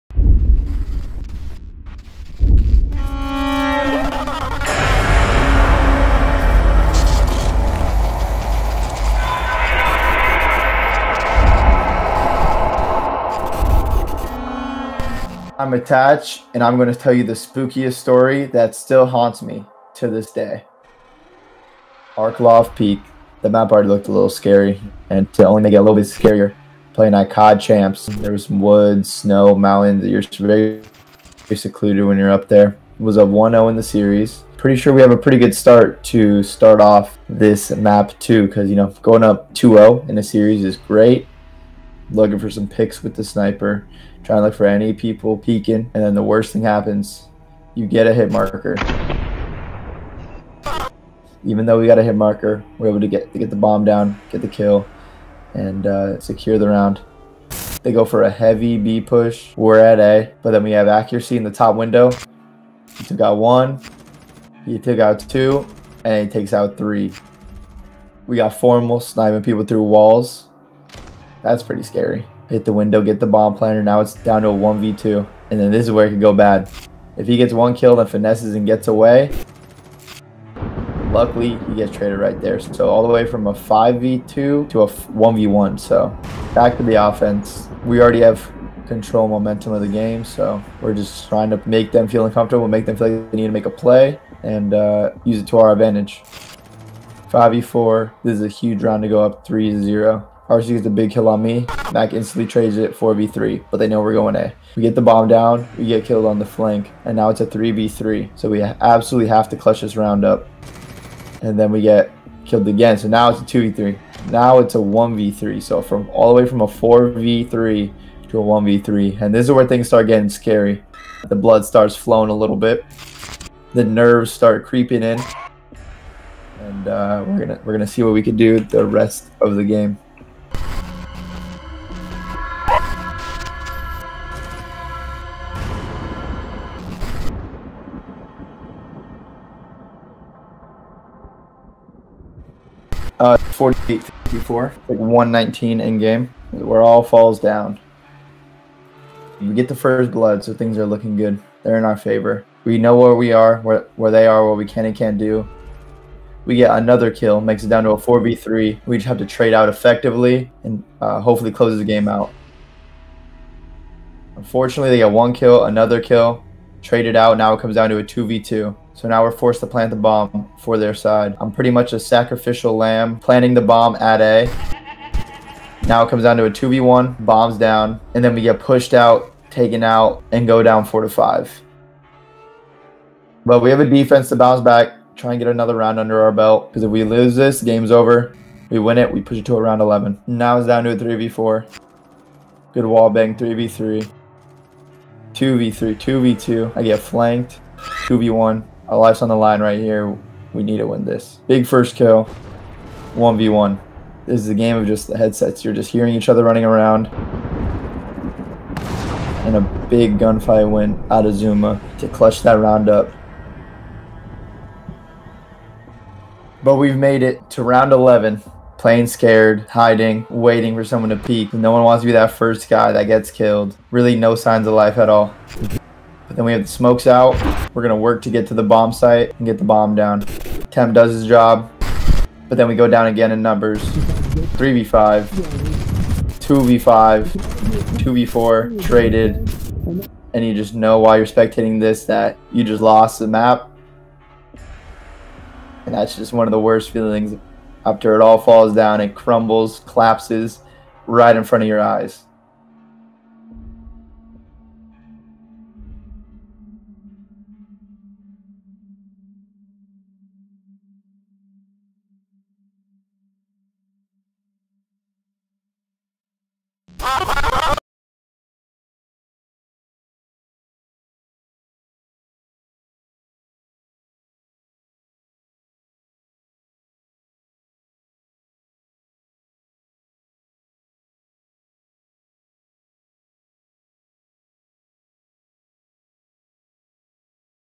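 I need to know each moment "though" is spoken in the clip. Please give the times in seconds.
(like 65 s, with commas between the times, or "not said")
51 s.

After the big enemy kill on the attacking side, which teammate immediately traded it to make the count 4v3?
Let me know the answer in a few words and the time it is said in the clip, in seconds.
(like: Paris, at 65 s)
Mac, at 101 s.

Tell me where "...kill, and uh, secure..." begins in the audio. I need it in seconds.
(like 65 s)
54 s.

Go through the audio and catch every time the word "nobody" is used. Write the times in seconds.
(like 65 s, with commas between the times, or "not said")
not said.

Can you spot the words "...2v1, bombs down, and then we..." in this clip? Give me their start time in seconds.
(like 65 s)
176 s.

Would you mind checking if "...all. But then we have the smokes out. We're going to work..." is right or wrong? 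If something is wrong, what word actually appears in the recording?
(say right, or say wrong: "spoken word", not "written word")
right.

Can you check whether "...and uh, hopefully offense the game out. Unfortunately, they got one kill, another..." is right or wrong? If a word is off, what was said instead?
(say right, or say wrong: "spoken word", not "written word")
wrong: "close", not "offense".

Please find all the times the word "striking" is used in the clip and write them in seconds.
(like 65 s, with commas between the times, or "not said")
not said.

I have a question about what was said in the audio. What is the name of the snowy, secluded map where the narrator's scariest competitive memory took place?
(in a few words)
Arklov Peak.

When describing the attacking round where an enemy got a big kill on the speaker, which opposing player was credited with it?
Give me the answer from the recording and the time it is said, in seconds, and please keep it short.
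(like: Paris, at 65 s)
RC, at 100 s.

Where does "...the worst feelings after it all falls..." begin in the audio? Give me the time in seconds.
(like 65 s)
246 s.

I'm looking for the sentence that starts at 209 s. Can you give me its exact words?
And a big gunfight went out of Zuma to clutch that round up.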